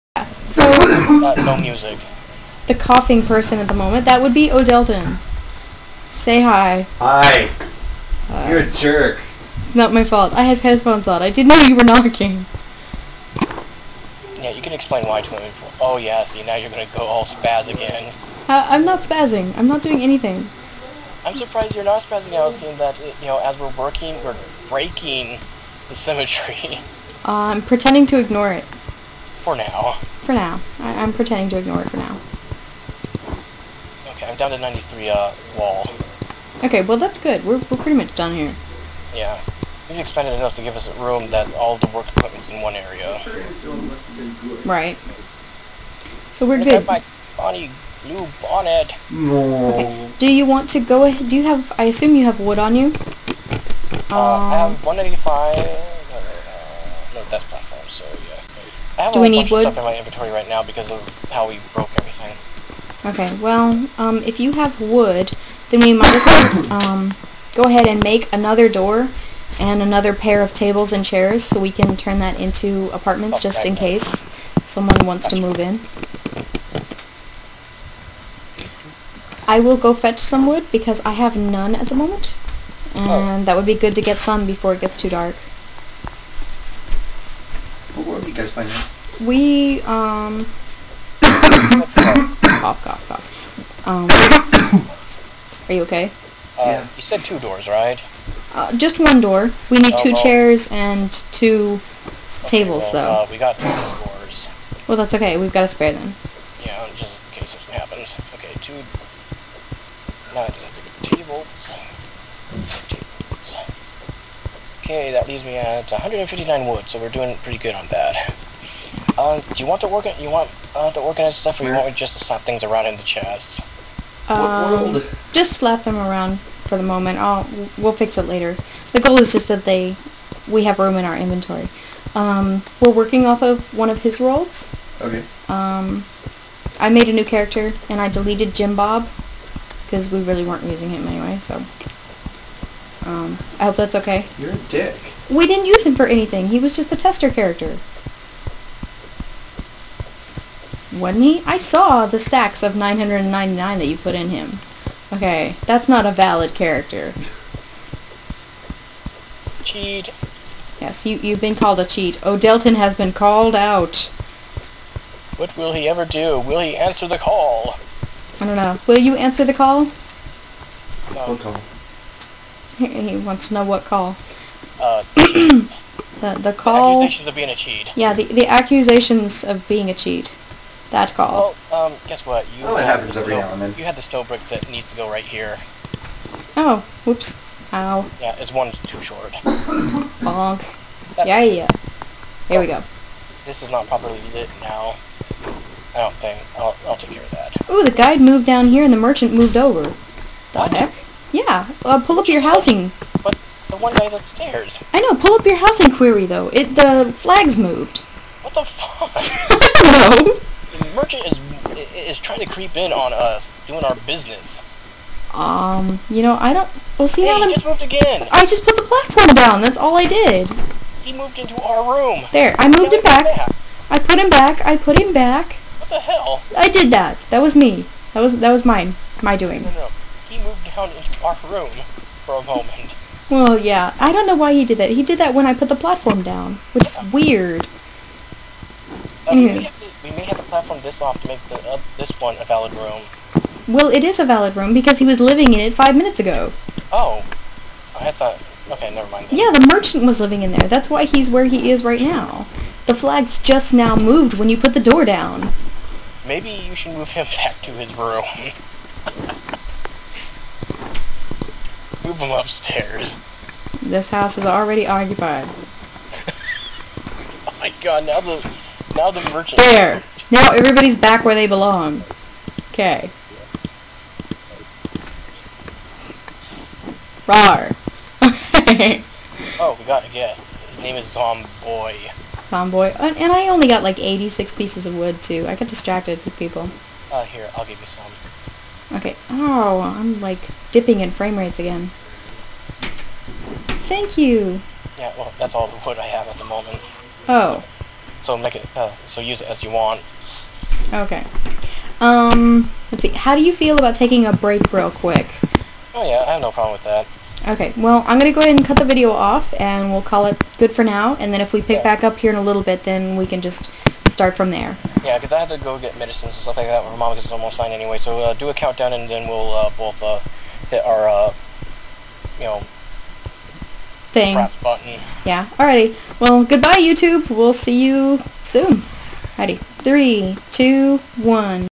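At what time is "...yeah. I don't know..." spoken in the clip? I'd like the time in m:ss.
3:53.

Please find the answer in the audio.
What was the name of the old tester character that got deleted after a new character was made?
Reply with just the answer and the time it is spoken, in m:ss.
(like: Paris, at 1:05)
Jim Bob, at 2:18.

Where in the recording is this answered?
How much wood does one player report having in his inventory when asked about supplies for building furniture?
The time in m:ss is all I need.
0:54.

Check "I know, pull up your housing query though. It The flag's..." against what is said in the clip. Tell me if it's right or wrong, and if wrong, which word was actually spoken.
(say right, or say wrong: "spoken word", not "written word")
right.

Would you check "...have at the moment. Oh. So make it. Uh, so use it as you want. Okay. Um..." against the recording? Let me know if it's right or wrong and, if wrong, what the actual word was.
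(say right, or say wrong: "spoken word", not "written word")
right.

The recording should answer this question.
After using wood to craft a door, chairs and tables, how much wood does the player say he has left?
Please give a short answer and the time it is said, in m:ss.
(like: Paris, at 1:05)
159, at 1:55.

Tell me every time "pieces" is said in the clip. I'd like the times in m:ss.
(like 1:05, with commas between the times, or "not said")
4:44.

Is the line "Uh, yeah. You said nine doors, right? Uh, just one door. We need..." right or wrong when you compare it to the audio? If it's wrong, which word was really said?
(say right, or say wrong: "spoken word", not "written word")
wrong: "two", not "nine".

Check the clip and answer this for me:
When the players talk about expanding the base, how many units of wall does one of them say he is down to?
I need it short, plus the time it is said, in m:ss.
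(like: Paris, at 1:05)
93, at 0:34.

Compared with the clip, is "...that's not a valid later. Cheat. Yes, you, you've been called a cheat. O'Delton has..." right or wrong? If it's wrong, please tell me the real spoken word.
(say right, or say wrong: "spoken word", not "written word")
wrong: "character", not "later".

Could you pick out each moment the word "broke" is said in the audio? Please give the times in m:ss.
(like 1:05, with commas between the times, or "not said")
1:01.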